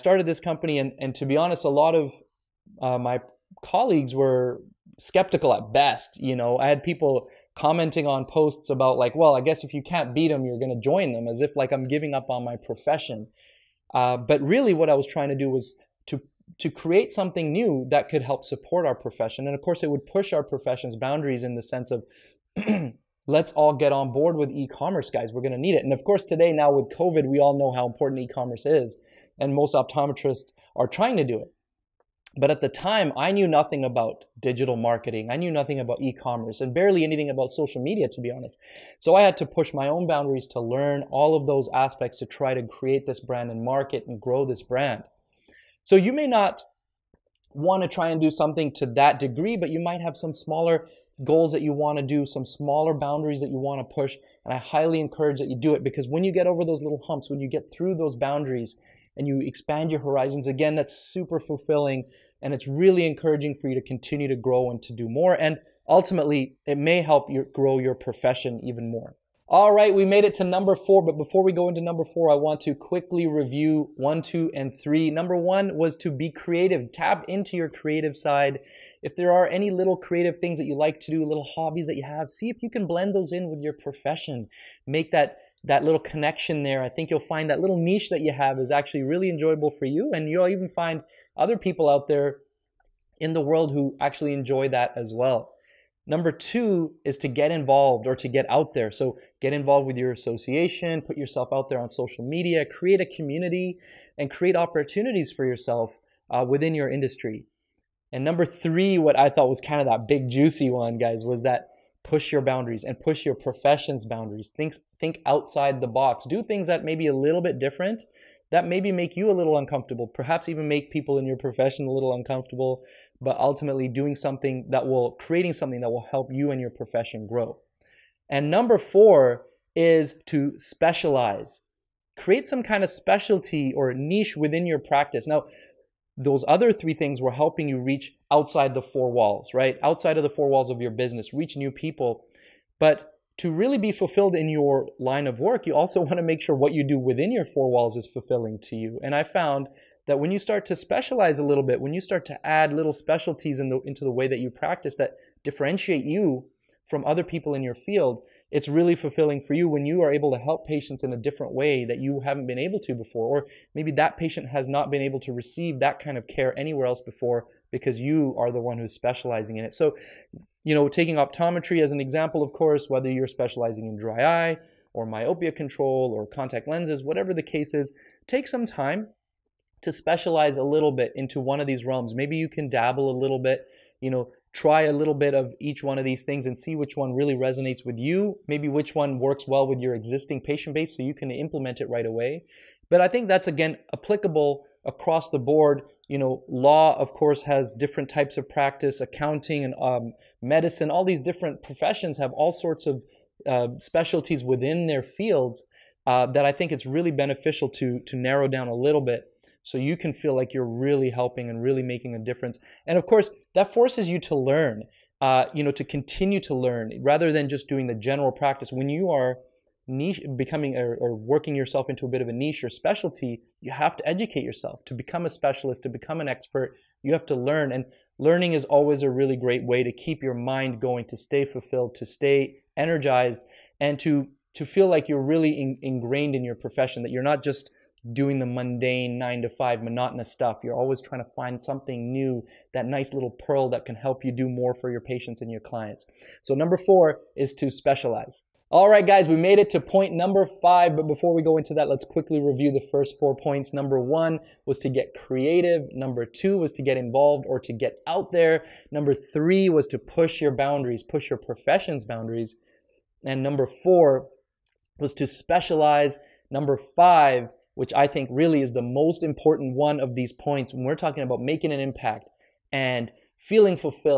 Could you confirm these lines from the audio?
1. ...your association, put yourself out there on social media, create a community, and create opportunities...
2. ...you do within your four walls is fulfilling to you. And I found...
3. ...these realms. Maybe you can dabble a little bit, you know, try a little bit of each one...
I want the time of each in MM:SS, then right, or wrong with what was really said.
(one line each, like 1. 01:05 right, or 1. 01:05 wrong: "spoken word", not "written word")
1. 01:39 right
2. 02:26 right
3. 03:01 right.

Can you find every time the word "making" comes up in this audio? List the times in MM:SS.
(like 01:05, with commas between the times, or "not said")
03:31, 04:31.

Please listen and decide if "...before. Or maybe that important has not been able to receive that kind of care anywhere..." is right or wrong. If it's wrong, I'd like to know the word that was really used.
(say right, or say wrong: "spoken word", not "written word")
wrong: "patient", not "important".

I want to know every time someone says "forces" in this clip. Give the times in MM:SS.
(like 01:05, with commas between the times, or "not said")
03:33.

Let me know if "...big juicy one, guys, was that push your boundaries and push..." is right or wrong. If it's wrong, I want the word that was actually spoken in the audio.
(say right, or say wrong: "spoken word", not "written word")
right.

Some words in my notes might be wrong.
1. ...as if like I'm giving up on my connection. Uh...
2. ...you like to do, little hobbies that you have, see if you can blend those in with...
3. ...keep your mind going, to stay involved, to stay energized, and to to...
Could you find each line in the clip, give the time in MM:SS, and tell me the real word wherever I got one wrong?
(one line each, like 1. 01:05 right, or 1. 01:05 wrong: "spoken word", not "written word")
1. 00:11 wrong: "profession", not "connection"
2. 01:20 right
3. 03:49 wrong: "fulfilled", not "involved".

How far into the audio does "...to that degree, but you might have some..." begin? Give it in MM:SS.
00:48.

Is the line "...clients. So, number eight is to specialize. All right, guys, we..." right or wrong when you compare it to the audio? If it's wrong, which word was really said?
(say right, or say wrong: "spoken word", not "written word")
wrong: "four", not "eight".